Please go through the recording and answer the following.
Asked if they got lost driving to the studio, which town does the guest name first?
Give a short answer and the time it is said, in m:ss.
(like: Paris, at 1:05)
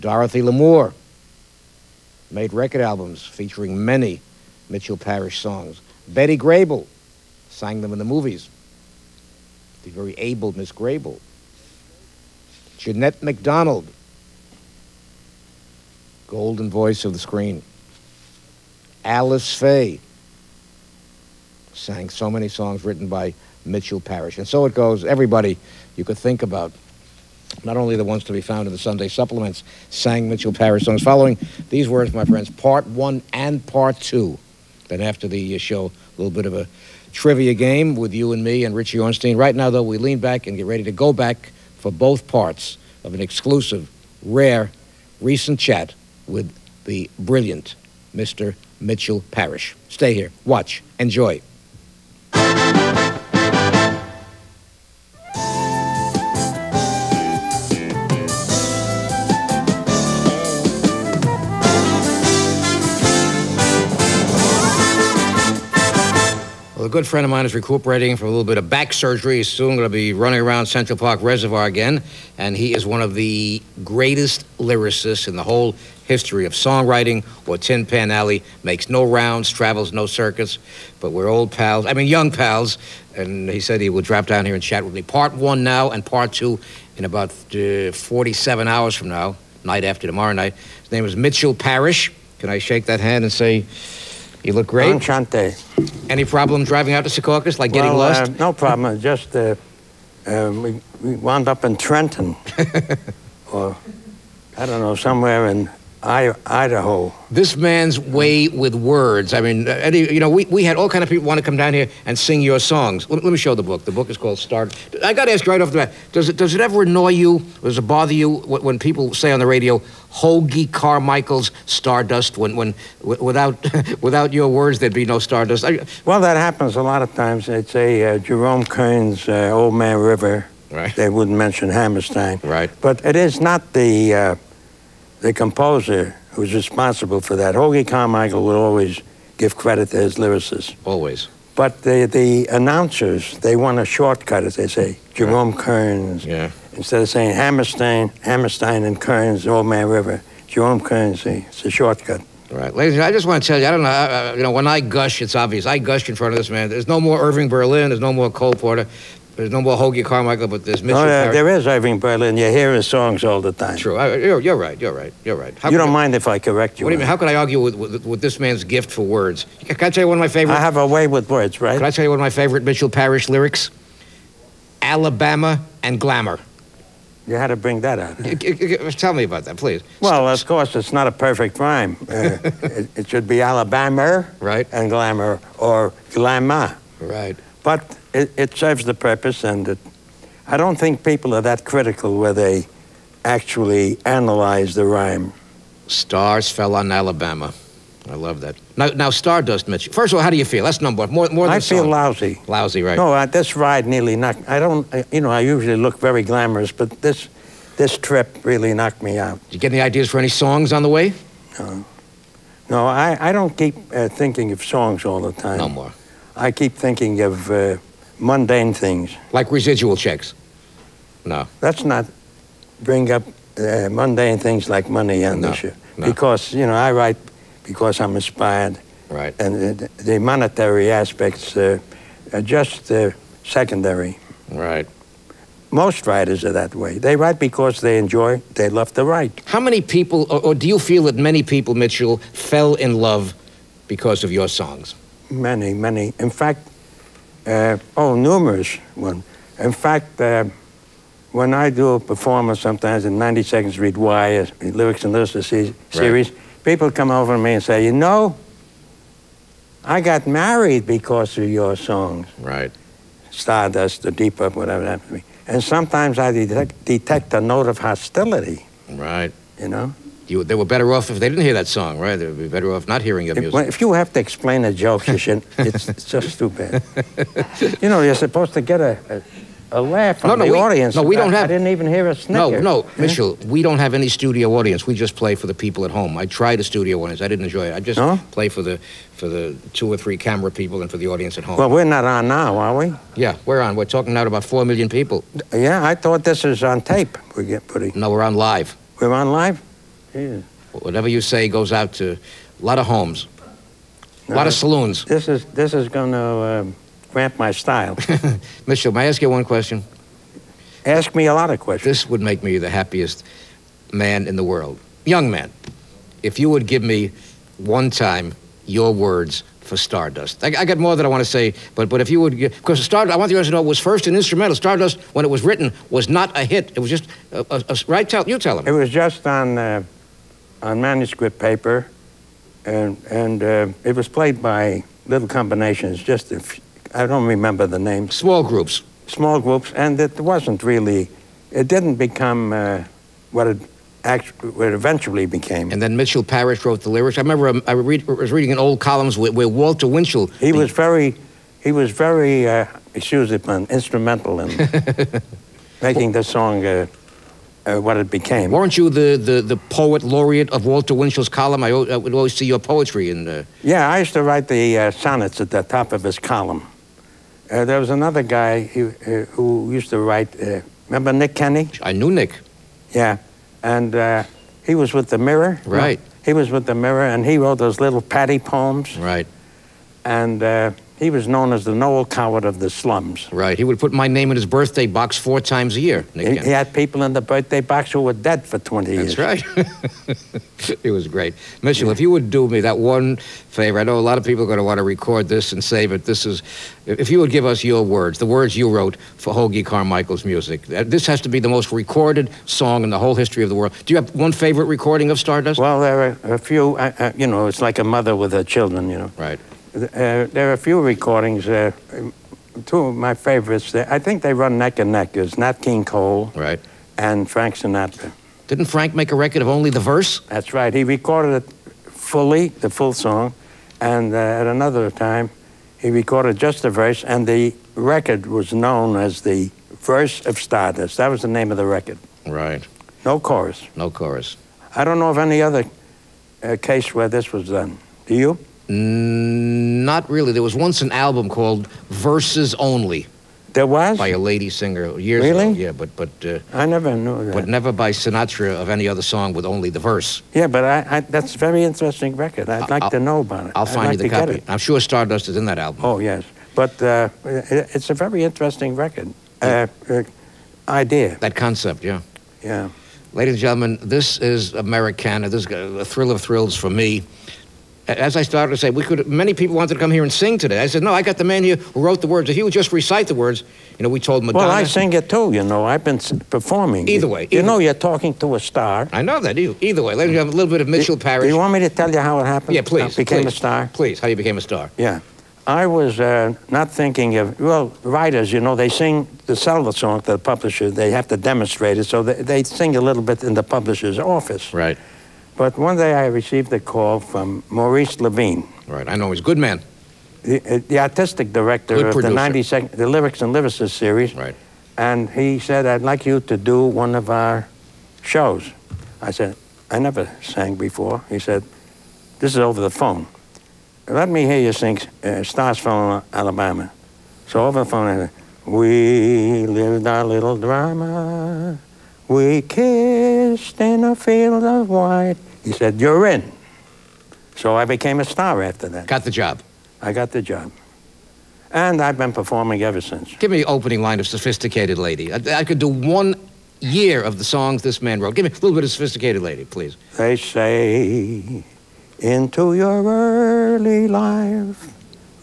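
Trenton, at 1:41.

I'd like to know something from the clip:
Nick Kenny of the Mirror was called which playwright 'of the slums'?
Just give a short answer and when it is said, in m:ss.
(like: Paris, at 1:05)
Noel Coward, at 6:21.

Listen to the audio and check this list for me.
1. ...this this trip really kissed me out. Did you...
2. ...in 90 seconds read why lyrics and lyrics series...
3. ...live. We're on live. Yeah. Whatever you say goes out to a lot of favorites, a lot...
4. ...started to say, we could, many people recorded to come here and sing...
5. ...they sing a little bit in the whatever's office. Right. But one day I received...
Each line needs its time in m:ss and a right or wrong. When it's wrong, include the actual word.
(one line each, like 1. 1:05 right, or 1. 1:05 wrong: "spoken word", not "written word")
1. 3:27 wrong: "knocked", not "kissed"
2. 4:13 right
3. 4:58 wrong: "homes", not "favorites"
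4. 7:48 wrong: "wanted", not "recorded"
5. 8:12 wrong: "publisher", not "whatever".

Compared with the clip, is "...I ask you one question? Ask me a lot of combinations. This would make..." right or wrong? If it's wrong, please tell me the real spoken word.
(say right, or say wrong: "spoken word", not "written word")
wrong: "questions", not "combinations".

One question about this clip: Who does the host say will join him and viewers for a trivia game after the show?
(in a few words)
Richie Ornstein.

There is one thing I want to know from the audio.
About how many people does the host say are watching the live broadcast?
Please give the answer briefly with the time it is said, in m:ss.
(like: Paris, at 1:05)
4 million, at 4:54.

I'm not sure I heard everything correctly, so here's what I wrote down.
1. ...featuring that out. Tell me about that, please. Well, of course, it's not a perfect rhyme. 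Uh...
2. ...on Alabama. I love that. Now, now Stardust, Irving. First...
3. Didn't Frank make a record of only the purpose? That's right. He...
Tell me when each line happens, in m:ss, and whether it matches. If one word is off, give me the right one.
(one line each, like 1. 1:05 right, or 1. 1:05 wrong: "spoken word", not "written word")
1. 2:57 wrong: "bring", not "featuring"
2. 3:16 wrong: "Mitch", not "Irving"
3. 6:58 wrong: "verse", not "purpose".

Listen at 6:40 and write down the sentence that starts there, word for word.
Uh, this has to be the most recorded song in the whole history of the world.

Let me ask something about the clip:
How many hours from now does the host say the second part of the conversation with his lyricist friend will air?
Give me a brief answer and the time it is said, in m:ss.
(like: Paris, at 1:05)
47, at 1:27.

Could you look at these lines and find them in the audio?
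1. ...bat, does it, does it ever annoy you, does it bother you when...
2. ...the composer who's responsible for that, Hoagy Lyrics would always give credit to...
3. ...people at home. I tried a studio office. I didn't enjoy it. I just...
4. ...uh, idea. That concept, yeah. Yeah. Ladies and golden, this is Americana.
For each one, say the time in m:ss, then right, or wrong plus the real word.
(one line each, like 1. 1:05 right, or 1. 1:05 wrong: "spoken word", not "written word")
1. 1:55 right
2. 2:15 wrong: "Carmichael", not "Lyrics"
3. 4:45 wrong: "audience", not "office"
4. 7:39 wrong: "gentlemen", not "golden".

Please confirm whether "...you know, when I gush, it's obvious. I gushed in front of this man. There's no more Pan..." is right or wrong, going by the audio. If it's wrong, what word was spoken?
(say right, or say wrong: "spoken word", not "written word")
wrong: "Irving", not "Pan".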